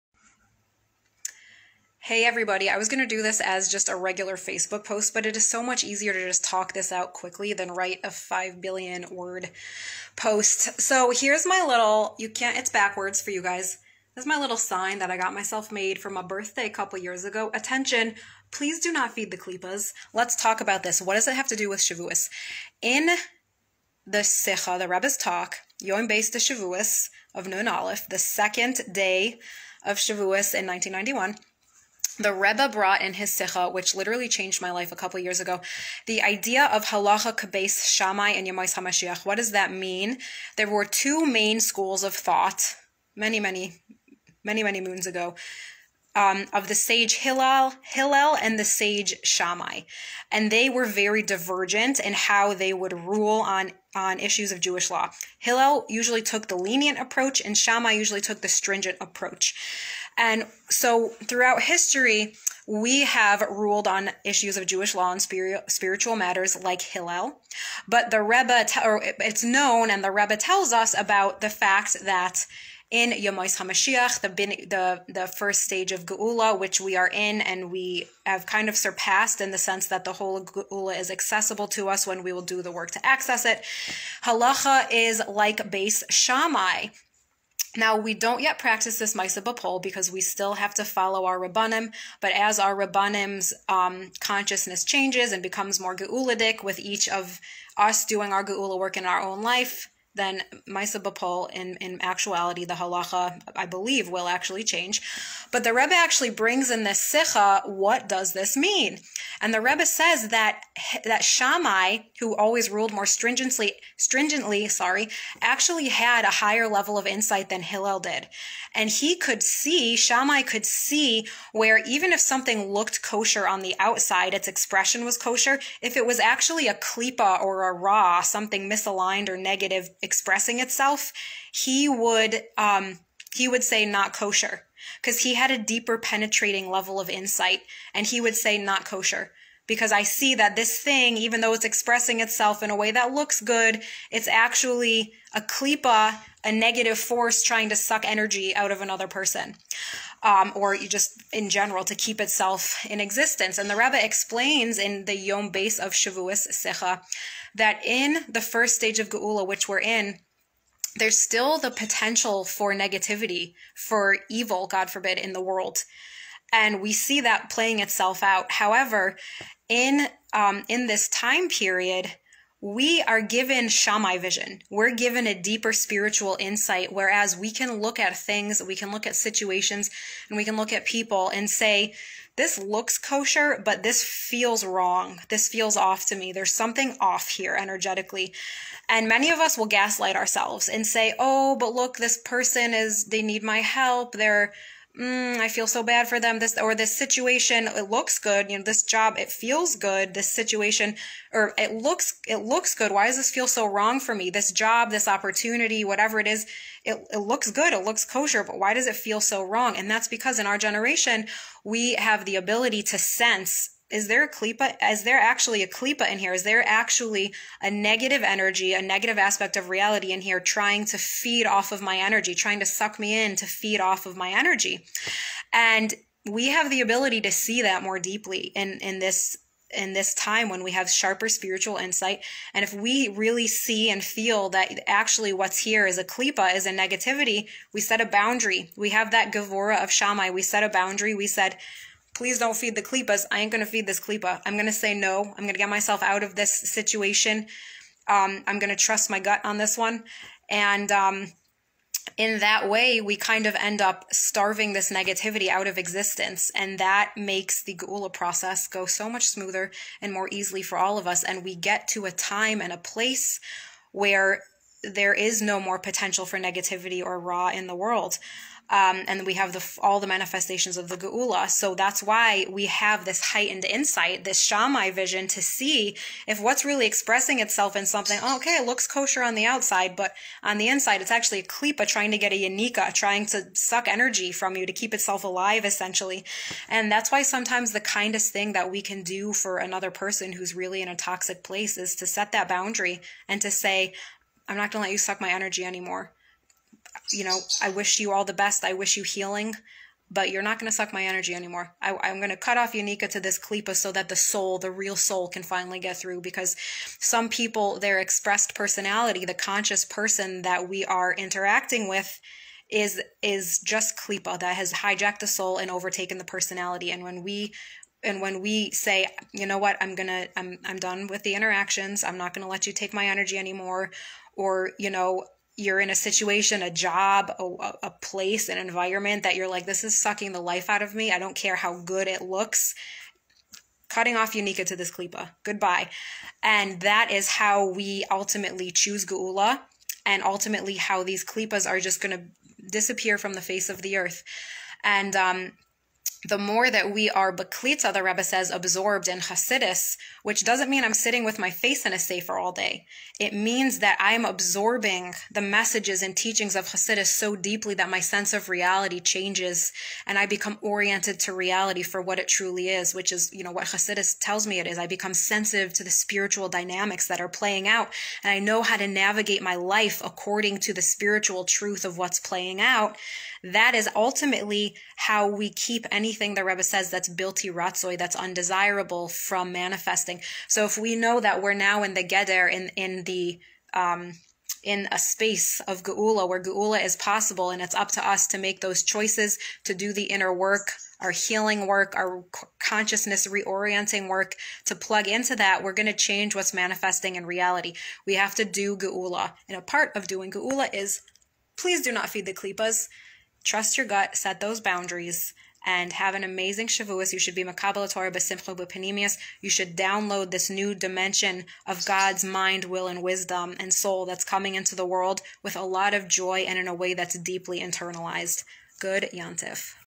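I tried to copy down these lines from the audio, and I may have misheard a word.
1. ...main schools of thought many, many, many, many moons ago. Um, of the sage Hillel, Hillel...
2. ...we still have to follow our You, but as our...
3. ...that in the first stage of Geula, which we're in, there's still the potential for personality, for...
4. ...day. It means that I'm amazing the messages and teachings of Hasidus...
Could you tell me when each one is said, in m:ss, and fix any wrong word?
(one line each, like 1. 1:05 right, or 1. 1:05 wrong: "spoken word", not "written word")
1. 0:41 right
2. 1:30 wrong: "Rabbanim", not "You"
3. 2:37 wrong: "negativity", not "personality"
4. 5:52 wrong: "absorbing", not "amazing".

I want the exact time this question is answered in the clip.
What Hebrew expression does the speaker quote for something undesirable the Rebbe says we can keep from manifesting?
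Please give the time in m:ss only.
6:17.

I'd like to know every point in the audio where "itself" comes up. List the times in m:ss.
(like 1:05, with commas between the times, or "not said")
2:10, 2:22, 2:32, 2:47, 4:37, 4:44.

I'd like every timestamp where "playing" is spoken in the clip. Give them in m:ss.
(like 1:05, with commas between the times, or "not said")
2:47, 6:07, 6:12.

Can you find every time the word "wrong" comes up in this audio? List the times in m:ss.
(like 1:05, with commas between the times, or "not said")
3:04, 3:23, 3:29.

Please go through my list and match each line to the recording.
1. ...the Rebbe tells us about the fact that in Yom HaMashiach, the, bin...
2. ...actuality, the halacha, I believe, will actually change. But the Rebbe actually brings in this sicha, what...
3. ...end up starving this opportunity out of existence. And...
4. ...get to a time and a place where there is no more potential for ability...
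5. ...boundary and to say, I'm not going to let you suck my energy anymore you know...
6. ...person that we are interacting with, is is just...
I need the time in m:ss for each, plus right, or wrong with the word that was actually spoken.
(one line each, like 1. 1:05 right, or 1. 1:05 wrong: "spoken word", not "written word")
1. 1:10 right
2. 1:42 right
3. 4:13 wrong: "negativity", not "opportunity"
4. 4:21 wrong: "negativity", not "ability"
5. 4:52 right
6. 5:09 right.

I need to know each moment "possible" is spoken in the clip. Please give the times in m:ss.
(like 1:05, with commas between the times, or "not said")
6:26.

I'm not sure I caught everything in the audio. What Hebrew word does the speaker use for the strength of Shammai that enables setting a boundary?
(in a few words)
gavura.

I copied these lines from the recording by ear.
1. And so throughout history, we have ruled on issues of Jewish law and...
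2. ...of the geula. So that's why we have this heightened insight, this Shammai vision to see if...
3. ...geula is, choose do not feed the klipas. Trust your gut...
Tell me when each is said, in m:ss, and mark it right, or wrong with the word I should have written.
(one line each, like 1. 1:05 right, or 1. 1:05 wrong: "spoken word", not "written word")
1. 1:00 right
2. 4:30 right
3. 6:40 wrong: "please", not "choose".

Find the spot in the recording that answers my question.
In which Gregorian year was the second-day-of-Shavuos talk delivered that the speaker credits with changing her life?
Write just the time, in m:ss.
0:30.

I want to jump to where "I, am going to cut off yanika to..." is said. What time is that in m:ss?
5:01.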